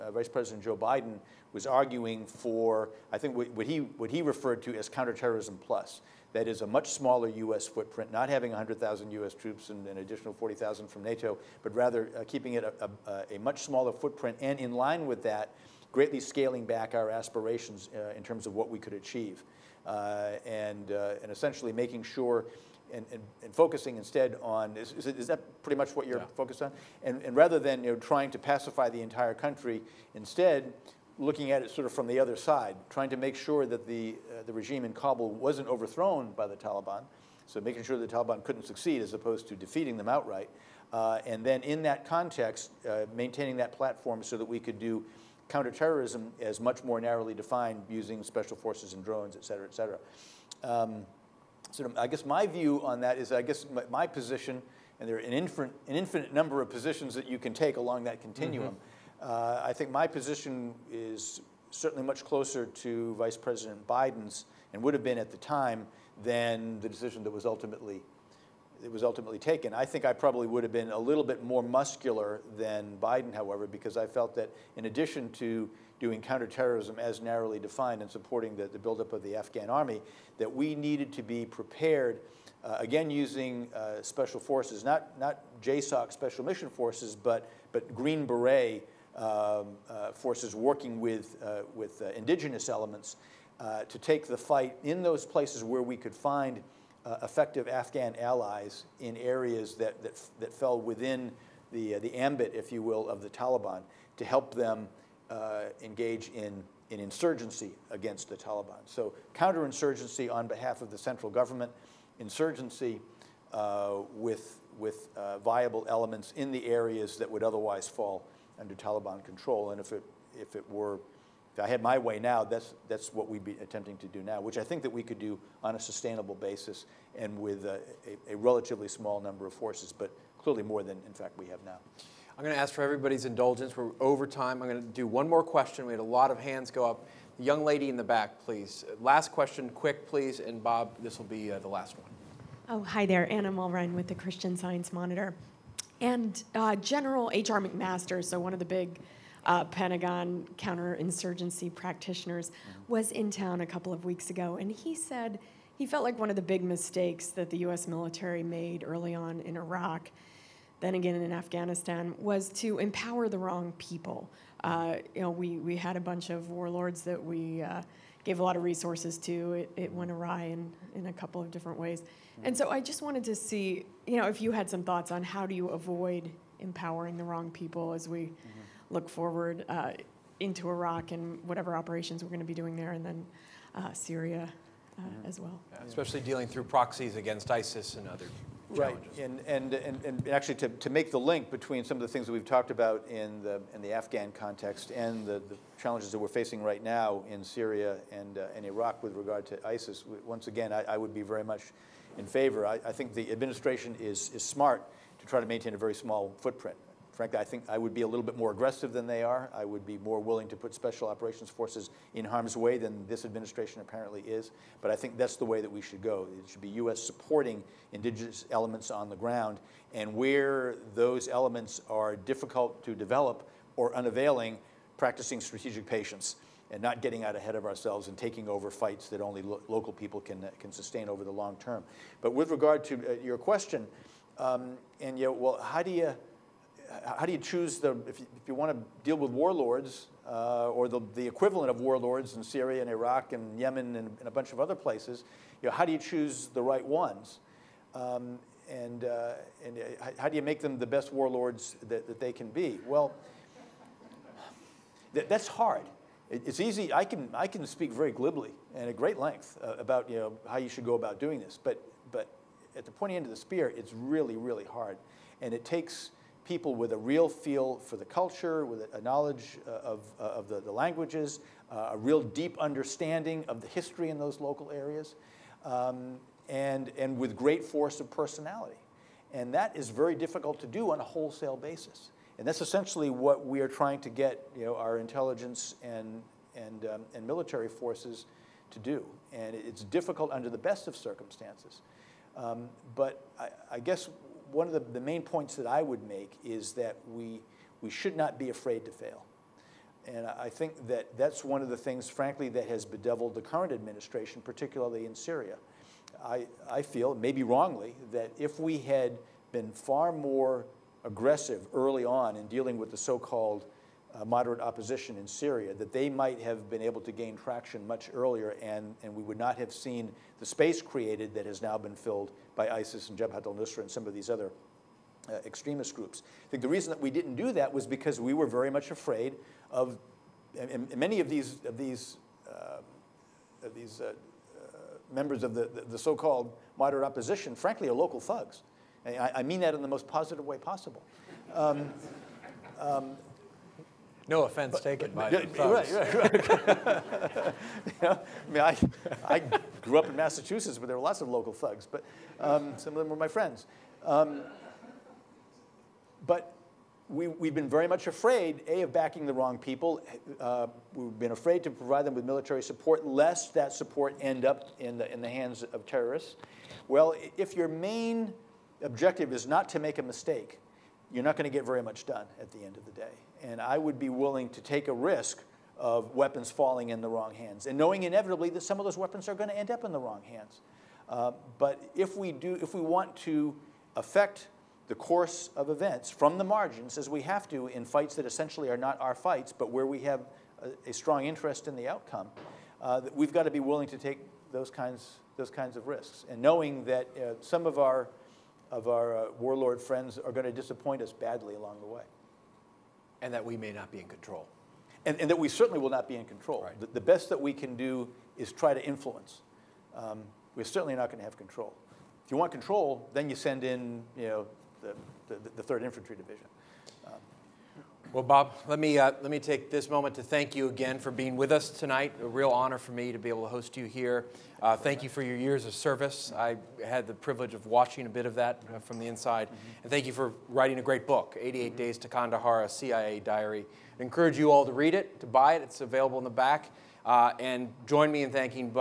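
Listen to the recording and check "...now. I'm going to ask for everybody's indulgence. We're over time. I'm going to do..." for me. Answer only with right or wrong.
right.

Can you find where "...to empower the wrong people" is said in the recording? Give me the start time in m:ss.
2:42.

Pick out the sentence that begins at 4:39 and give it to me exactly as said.
And that is very difficult to do on a wholesale basis.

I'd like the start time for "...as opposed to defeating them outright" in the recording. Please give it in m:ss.
0:39.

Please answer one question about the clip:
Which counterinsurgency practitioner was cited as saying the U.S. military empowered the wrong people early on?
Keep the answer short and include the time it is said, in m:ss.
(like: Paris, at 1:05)
H.R. McMaster, at 2:27.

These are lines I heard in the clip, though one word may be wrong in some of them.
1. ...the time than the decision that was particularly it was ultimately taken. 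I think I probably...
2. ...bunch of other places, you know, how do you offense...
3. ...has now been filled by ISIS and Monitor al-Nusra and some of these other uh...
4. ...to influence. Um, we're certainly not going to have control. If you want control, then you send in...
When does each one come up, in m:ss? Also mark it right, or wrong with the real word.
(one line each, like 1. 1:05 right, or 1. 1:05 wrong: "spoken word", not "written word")
1. 1:05 wrong: "ultimately", not "particularly"
2. 4:04 wrong: "choose", not "offense"
3. 5:21 wrong: "Jabhat", not "Monitor"
4. 6:48 right.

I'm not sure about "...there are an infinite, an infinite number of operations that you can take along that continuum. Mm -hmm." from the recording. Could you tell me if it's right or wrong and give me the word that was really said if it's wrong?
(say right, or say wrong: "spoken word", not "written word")
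wrong: "positions", not "operations".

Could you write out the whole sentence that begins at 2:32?
was in town a couple of weeks ago, and he said he felt like one of the big mistakes that the U.S.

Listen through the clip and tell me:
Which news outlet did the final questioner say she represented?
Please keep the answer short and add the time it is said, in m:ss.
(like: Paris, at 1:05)
Christian Science Monitor, at 2:24.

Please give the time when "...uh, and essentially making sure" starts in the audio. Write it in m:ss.
0:20.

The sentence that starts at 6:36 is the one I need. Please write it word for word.
And knowing that uh, some of our of our uh, warlord friends are going to disappoint us badly along the way.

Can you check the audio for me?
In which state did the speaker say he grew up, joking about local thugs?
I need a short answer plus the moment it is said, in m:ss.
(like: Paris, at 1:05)
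Massachusetts, at 5:50.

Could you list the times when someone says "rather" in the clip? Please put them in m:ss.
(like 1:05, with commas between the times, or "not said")
0:11, 0:27.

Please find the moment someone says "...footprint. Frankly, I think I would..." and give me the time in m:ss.
3:26.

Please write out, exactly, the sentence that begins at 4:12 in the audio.
Well, th that's hard it's easy.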